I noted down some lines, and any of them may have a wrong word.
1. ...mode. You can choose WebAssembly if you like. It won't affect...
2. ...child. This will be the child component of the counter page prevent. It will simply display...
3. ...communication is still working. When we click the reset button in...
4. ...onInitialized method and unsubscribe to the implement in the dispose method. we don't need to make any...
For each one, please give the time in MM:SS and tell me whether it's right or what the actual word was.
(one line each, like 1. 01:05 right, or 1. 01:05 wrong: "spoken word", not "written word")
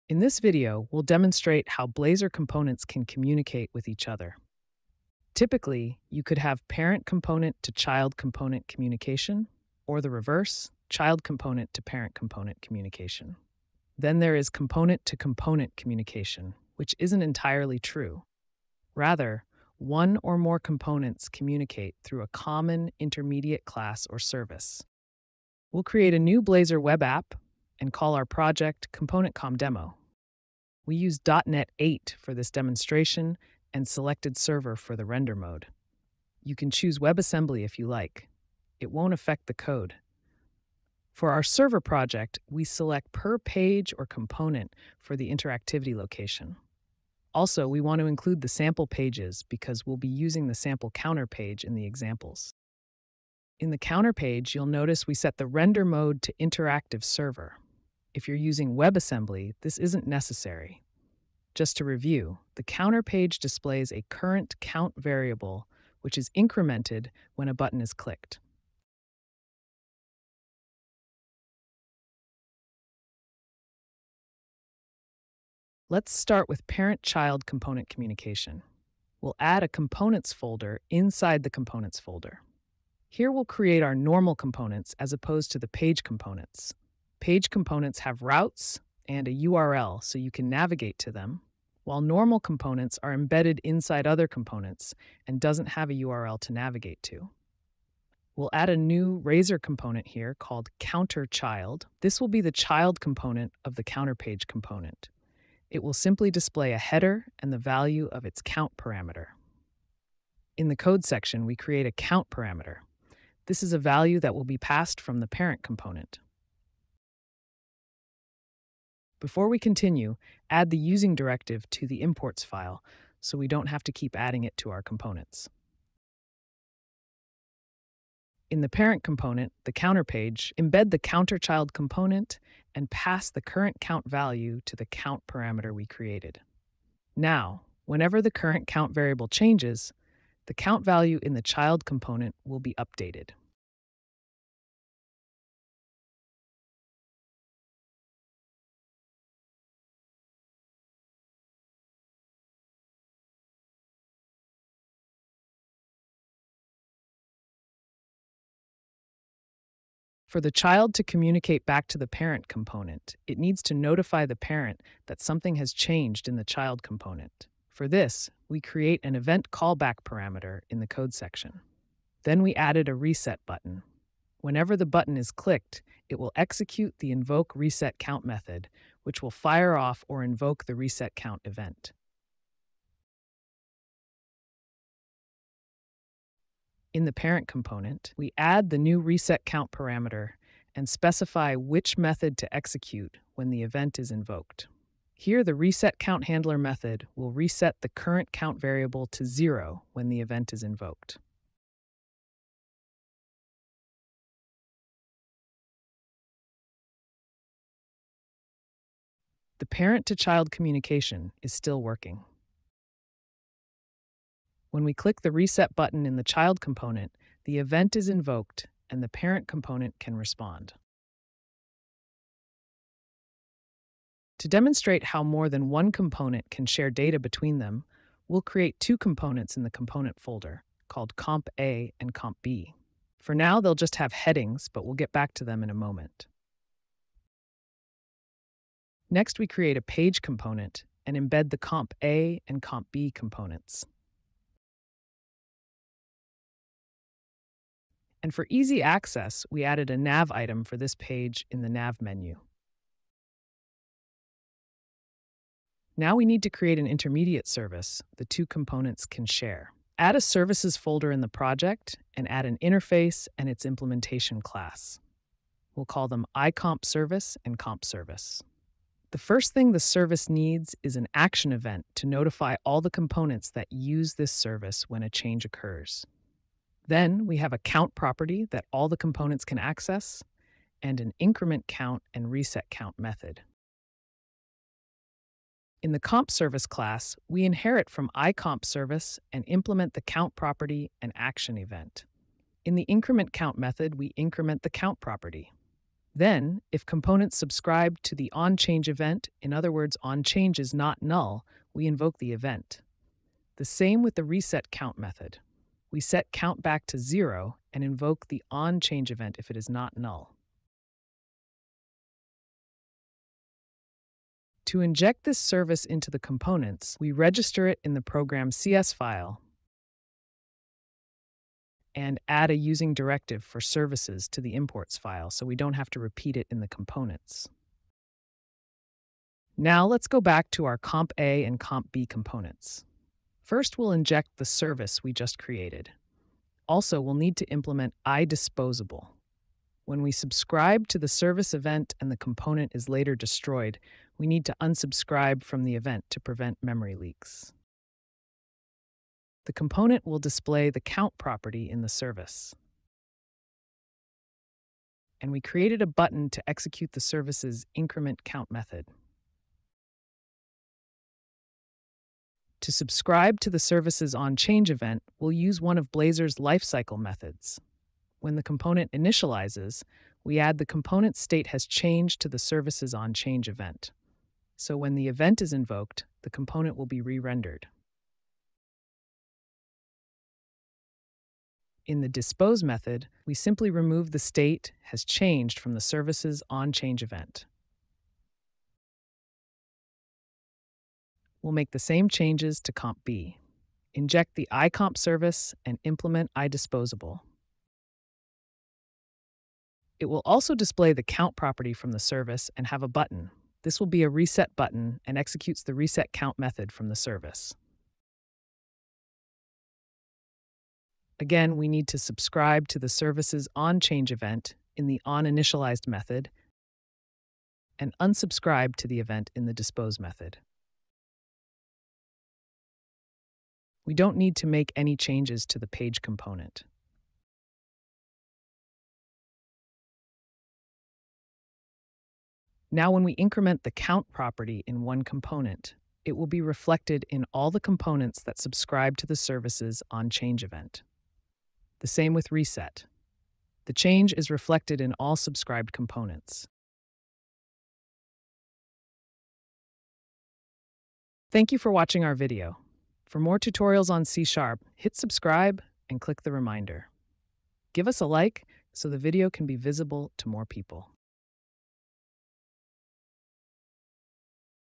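1. 00:35 right
2. 01:41 wrong: "component", not "prevent"
3. 03:30 right
4. 06:55 wrong: "event", not "implement".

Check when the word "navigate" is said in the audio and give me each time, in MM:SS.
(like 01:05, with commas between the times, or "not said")
01:30, 01:36.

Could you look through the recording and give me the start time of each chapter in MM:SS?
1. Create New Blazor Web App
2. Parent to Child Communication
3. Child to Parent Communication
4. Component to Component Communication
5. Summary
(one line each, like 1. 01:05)
1. 00:25
2. 01:15
3. 02:40
4. 03:43
5. 07:30.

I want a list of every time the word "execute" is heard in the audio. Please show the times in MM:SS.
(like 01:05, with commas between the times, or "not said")
02:56, 03:12, 05:56, 06:45.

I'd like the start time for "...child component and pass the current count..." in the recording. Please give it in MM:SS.
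02:11.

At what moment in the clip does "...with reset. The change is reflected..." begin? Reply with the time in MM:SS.
07:22.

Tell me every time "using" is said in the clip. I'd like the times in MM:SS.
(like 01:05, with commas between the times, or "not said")
00:50, 00:58, 02:00, 05:22.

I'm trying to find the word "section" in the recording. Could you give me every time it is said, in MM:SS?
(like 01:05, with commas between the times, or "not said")
01:51, 02:51.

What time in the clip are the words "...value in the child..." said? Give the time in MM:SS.
02:20.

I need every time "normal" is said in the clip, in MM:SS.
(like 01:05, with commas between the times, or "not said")
01:23, 01:32.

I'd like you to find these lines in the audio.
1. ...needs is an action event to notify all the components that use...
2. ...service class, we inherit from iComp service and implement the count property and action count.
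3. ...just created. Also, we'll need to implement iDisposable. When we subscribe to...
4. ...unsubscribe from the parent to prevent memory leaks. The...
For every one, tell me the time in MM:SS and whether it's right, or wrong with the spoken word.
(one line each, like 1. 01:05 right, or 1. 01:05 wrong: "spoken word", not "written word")
1. 04:30 right
2. 04:46 wrong: "event", not "count"
3. 05:35 right
4. 05:44 wrong: "event", not "parent".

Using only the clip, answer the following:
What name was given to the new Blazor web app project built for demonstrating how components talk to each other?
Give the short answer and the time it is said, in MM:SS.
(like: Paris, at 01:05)
ComponentCom Demo, at 00:28.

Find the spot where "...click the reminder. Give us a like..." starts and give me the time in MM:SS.
07:35.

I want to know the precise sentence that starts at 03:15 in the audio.
Here, the reset count handler method will reset the current count variable to zero when the event is invoked.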